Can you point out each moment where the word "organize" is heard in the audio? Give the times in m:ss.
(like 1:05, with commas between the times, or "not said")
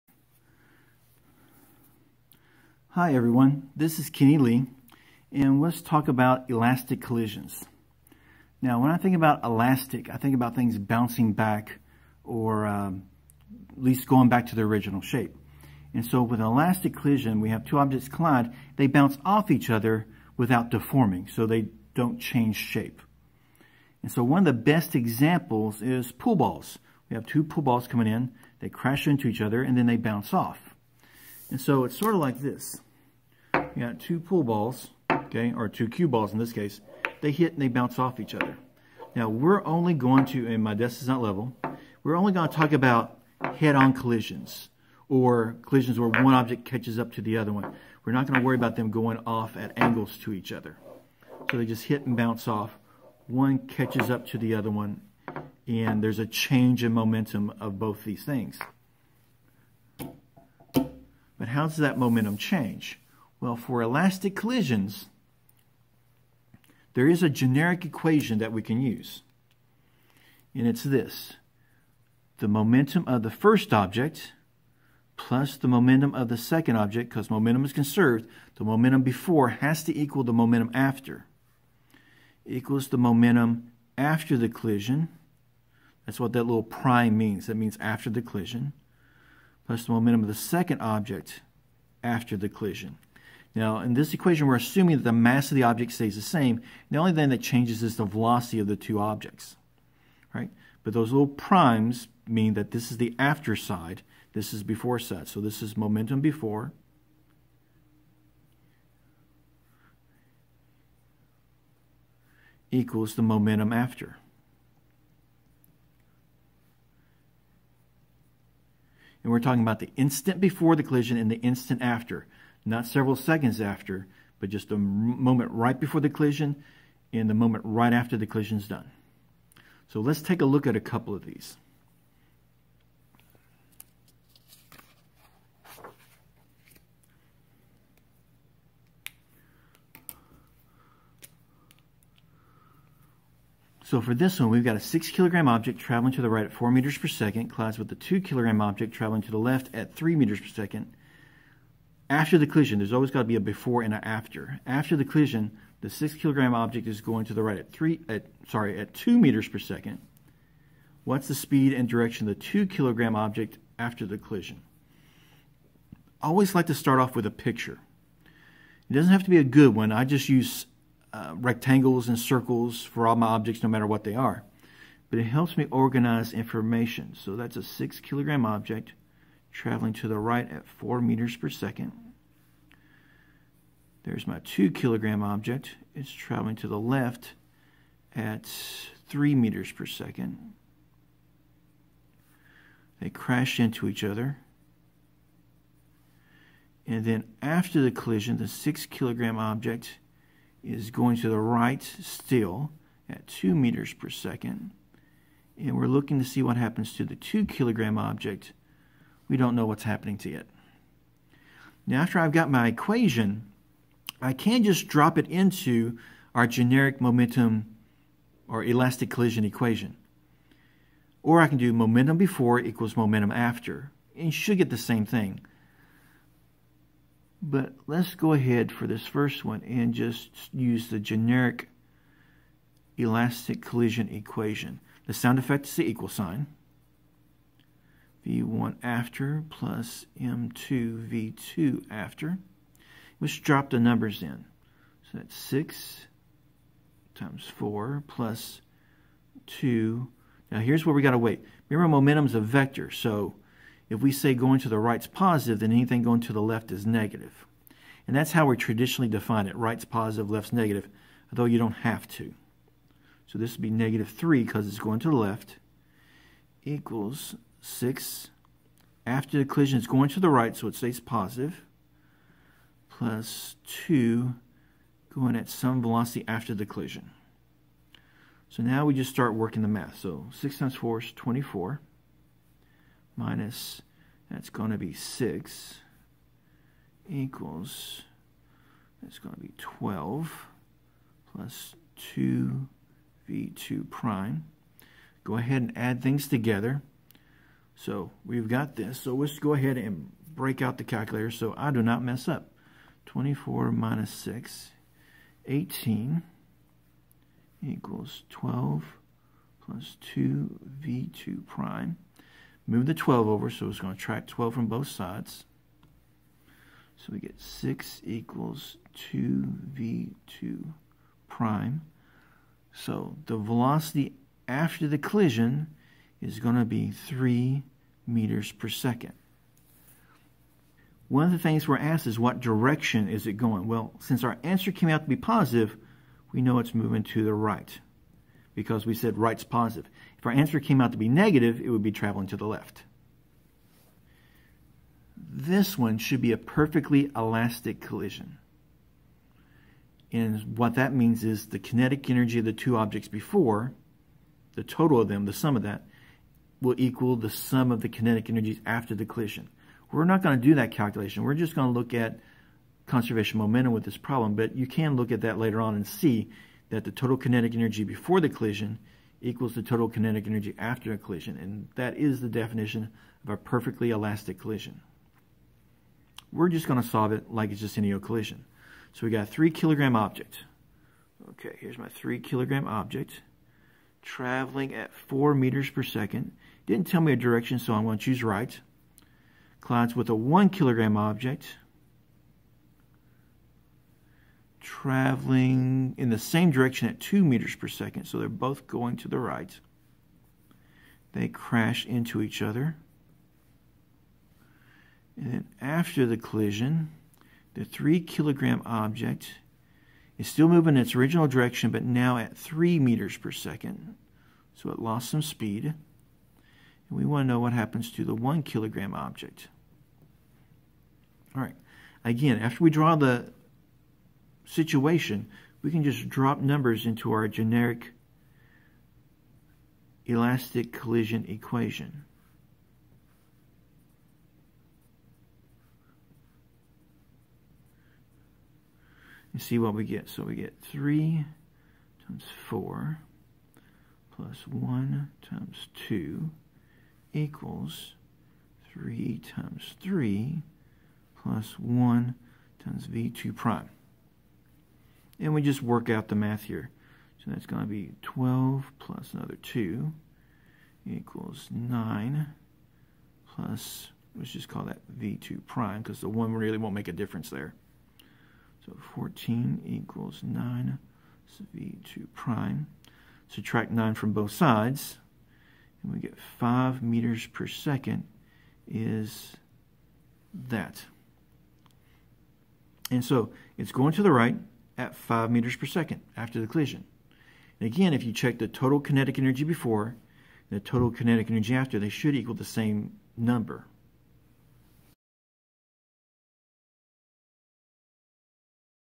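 2:55.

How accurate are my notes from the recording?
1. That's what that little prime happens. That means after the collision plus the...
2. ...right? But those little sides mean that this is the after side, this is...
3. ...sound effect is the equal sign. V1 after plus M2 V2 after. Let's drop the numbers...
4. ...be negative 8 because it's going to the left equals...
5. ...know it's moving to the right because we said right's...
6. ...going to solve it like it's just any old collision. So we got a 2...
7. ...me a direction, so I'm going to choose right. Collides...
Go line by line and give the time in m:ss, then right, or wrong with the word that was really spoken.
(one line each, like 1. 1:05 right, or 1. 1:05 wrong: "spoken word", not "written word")
1. 1:26 wrong: "means", not "happens"
2. 1:40 wrong: "primes", not "sides"
3. 3:55 right
4. 4:23 wrong: "3", not "8"
5. 5:36 right
6. 6:16 wrong: "3", not "2"
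7. 6:27 right.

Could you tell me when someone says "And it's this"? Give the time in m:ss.
1:10.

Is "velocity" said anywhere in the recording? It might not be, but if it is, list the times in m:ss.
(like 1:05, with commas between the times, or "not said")
1:38, 4:35, 5:23.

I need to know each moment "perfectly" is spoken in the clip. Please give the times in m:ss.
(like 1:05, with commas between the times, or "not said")
5:46, 6:13.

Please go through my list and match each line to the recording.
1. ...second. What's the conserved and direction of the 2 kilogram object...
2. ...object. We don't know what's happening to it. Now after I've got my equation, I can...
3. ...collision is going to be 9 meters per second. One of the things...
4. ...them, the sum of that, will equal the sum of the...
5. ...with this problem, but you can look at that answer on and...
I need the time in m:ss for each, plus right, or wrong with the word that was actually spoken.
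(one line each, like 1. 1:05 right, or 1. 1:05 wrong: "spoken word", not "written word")
1. 2:39 wrong: "speed", not "conserved"
2. 3:27 right
3. 5:24 wrong: "3", not "9"
4. 5:55 right
5. 6:03 wrong: "later", not "answer".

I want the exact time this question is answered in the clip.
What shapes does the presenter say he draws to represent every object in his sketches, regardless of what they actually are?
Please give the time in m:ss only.
2:51.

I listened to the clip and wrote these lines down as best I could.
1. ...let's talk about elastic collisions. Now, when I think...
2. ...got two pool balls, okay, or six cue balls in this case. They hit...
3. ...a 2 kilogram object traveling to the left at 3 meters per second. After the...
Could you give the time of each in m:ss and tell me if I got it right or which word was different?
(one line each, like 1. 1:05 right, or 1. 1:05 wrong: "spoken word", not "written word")
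1. 0:05 right
2. 0:33 wrong: "two", not "six"
3. 2:27 right.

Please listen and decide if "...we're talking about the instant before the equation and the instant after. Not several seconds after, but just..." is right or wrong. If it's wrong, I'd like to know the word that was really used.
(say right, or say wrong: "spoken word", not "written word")
wrong: "collision", not "equation".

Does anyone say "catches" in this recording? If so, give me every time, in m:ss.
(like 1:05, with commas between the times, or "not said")
0:46, 0:53.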